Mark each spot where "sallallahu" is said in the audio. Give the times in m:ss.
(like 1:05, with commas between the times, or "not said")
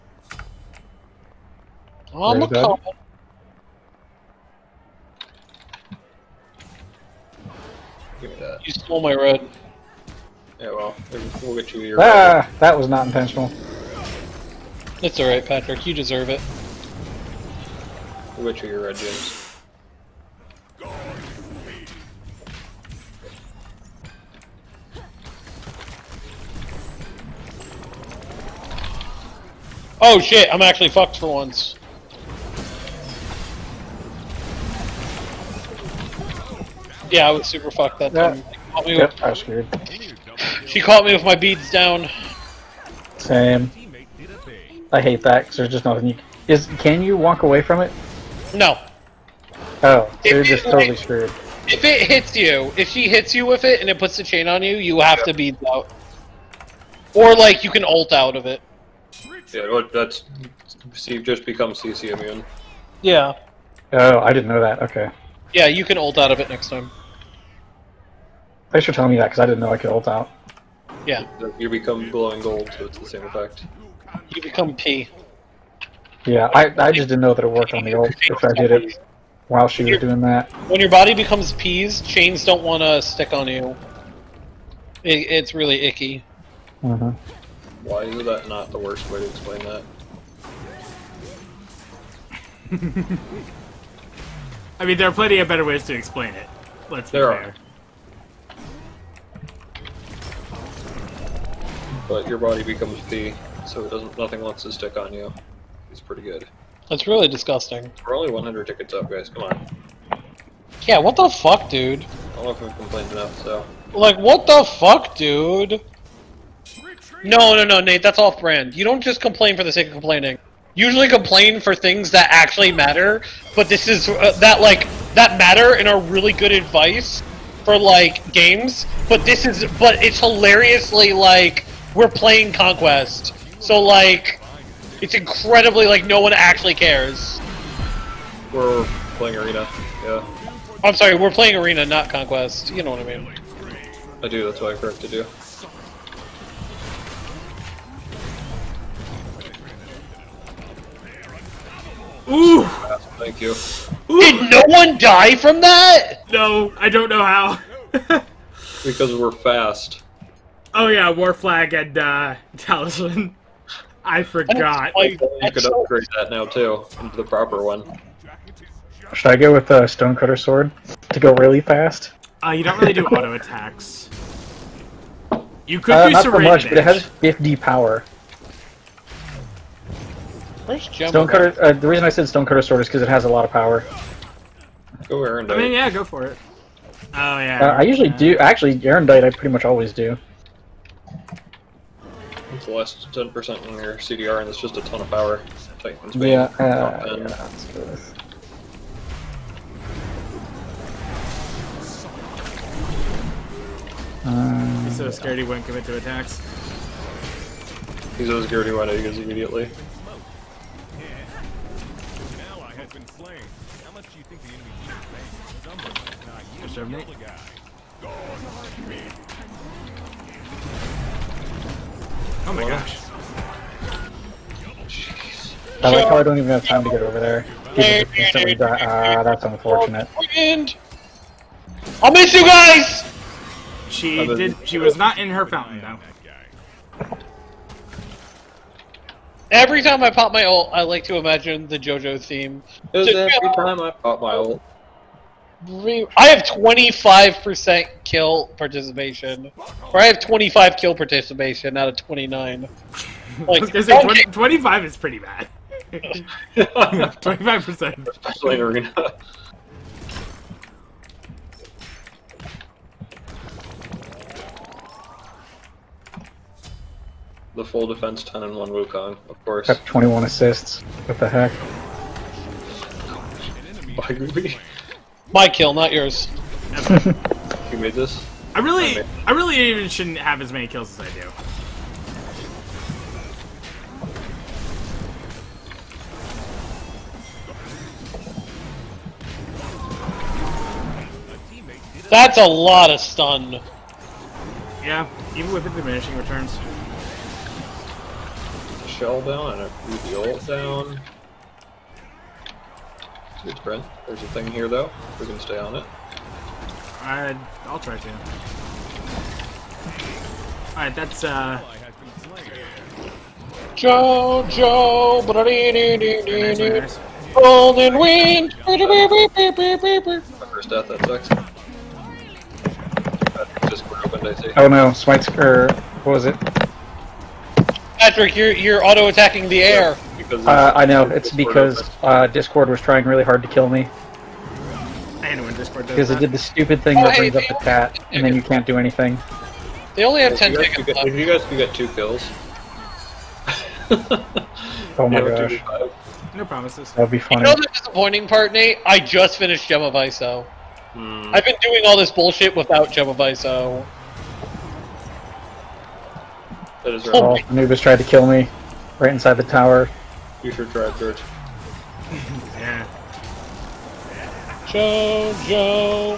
not said.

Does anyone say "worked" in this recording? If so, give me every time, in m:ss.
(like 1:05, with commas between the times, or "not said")
1:17.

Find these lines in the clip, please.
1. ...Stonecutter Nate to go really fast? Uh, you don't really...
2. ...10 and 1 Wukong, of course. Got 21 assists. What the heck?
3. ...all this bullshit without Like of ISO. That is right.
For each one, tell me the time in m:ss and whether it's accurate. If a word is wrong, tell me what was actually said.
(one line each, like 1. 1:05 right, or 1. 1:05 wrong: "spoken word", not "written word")
1. 2:49 wrong: "Sword", not "Nate"
2. 4:28 right
3. 5:51 wrong: "Gem", not "Like".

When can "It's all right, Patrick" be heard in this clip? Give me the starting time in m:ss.
0:15.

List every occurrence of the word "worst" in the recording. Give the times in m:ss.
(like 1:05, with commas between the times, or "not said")
1:28.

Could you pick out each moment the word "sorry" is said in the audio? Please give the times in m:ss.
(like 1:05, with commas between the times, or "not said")
2:20.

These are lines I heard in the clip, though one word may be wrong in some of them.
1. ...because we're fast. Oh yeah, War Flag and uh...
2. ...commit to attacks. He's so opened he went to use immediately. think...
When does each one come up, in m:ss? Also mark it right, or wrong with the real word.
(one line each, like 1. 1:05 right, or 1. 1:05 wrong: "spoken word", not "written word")
1. 2:38 right
2. 3:25 wrong: "scared", not "opened".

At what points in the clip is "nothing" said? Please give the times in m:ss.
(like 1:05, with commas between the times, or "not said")
0:45, 1:44.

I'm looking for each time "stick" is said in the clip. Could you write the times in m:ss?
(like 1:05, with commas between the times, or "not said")
1:23, 1:44.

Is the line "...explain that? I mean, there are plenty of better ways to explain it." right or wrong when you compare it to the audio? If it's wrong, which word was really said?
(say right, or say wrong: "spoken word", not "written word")
right.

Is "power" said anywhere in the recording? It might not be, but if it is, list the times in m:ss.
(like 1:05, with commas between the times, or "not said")
2:57, 3:03, 3:15.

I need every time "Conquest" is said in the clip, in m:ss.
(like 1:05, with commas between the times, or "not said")
2:12, 2:22.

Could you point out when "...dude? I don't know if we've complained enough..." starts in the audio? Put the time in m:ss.
1:51.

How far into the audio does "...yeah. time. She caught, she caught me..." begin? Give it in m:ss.
0:38.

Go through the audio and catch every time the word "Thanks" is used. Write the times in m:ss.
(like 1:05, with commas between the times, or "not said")
1:08, 2:33.